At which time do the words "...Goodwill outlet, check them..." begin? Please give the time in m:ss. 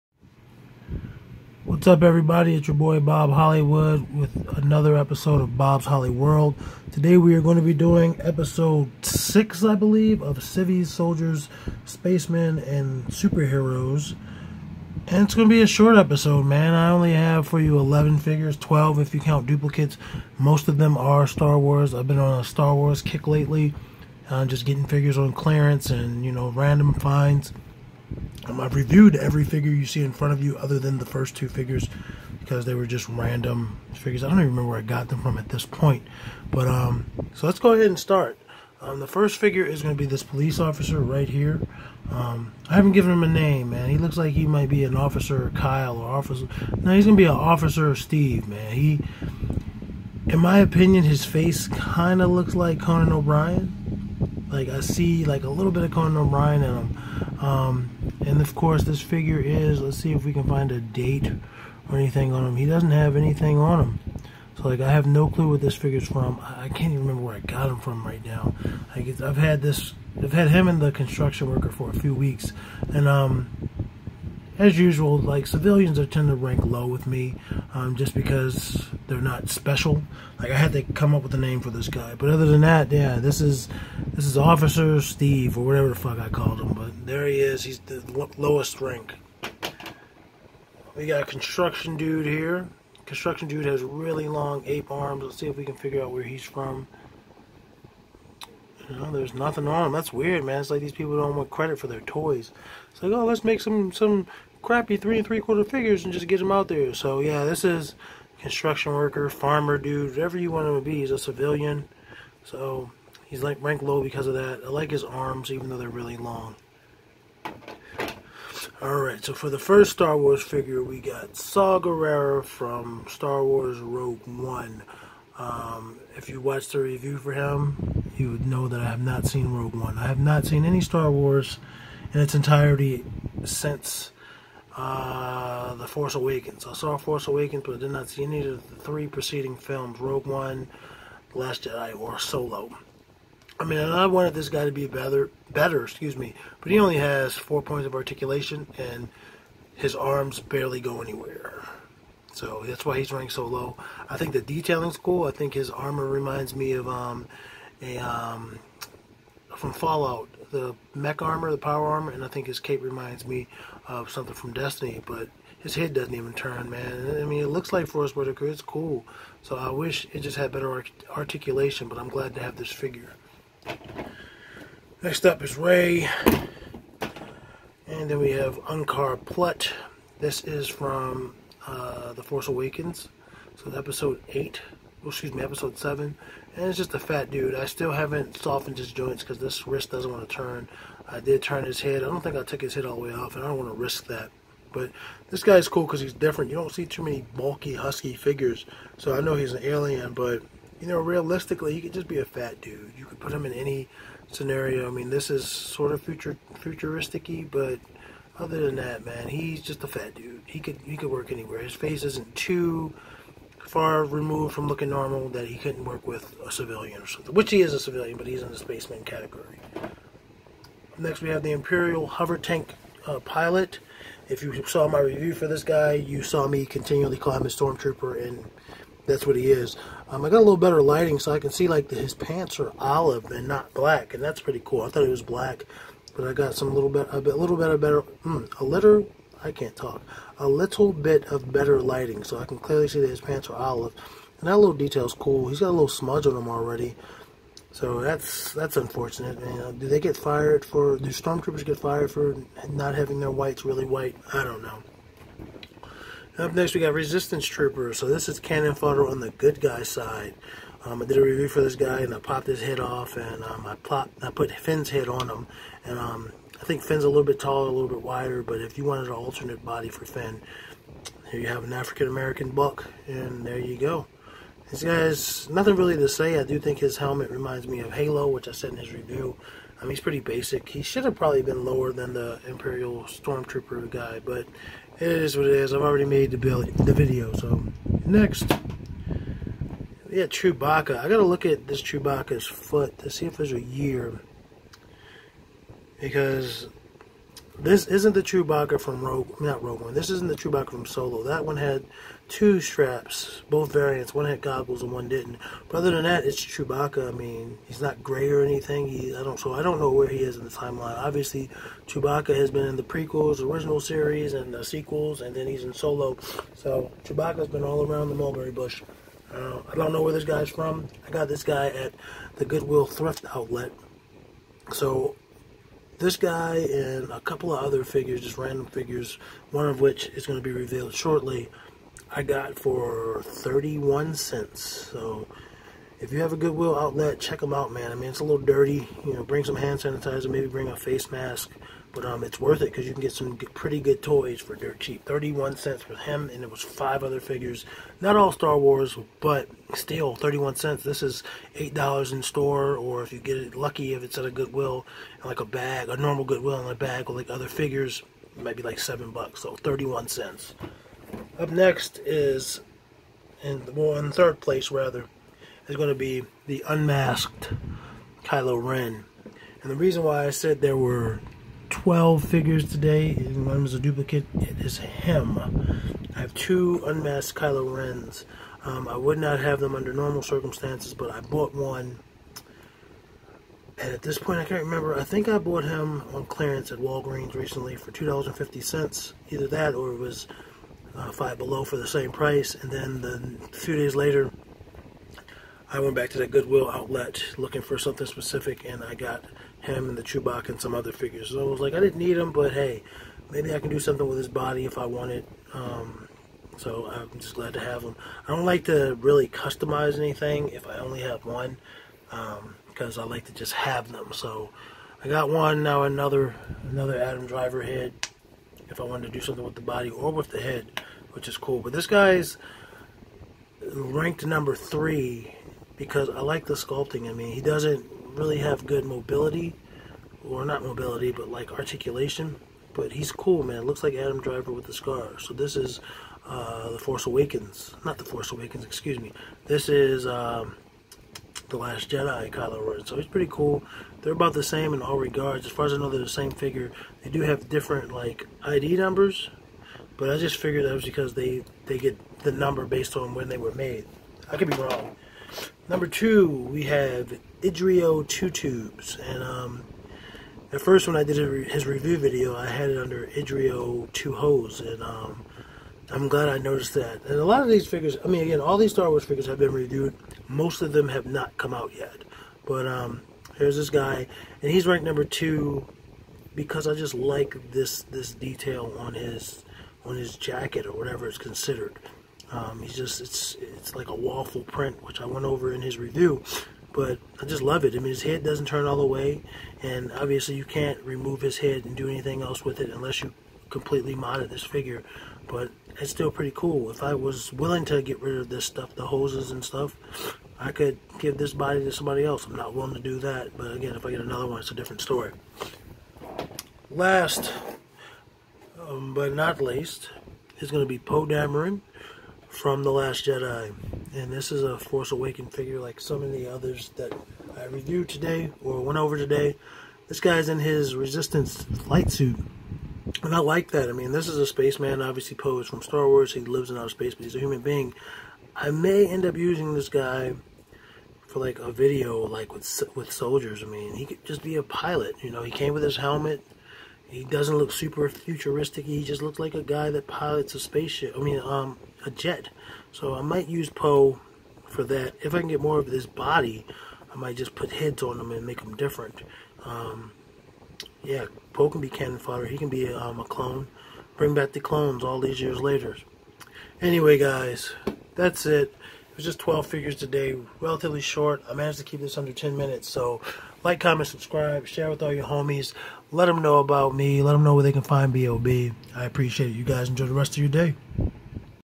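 5:36.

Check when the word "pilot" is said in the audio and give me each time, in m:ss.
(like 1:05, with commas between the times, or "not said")
3:43, 8:54, 8:59.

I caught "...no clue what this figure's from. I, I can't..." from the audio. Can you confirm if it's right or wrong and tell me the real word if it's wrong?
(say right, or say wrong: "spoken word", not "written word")
right.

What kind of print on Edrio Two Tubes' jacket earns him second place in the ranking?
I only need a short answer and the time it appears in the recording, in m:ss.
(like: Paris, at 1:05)
Waffle print, at 8:03.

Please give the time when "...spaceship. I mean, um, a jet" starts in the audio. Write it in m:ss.
9:00.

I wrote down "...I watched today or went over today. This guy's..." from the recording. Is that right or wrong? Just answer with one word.
wrong.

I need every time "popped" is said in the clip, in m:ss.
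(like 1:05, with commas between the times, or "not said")
4:22.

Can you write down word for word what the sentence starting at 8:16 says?
If I was willing to get rid of this stuff, the hoses and stuff, I could give this body to somebody else.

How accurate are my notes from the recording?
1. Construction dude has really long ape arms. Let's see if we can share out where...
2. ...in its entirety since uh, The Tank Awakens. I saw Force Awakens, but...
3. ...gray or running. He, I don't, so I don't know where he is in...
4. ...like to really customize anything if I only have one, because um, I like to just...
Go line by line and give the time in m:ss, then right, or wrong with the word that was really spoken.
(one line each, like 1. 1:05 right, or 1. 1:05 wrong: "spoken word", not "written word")
1. 1:33 wrong: "figure", not "share"
2. 2:12 wrong: "Force", not "Tank"
3. 5:08 wrong: "anything", not "running"
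4. 6:48 right.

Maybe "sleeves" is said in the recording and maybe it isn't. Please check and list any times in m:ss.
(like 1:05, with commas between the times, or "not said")
not said.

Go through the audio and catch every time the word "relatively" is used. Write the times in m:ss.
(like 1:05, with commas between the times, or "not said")
9:20.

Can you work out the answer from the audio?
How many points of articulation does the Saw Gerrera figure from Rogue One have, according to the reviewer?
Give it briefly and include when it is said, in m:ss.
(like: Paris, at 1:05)
4, at 2:27.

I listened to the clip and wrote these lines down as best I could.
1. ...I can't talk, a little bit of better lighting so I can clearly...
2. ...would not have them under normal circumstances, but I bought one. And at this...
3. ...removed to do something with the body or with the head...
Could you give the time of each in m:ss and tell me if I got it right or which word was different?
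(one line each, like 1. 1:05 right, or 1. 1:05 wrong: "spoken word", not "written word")
1. 3:59 right
2. 6:18 right
3. 6:58 wrong: "wanted", not "removed".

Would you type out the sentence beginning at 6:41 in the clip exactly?
So I was like, I didn't need them, but hey, maybe I can do something with his body if I wanted.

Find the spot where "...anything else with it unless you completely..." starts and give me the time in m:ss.
8:11.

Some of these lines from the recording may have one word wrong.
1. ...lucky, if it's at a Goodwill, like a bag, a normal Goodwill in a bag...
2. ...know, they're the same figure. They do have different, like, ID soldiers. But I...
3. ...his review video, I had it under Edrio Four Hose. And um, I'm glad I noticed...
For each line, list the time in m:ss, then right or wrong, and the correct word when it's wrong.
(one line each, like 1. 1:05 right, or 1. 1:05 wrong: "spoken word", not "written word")
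1. 5:53 right
2. 7:25 wrong: "numbers", not "soldiers"
3. 7:41 wrong: "Two", not "Four".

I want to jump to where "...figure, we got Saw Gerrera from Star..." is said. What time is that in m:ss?
2:00.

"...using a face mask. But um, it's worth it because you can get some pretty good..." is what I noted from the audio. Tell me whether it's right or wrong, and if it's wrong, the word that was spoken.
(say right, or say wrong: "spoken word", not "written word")
wrong: "bring", not "using".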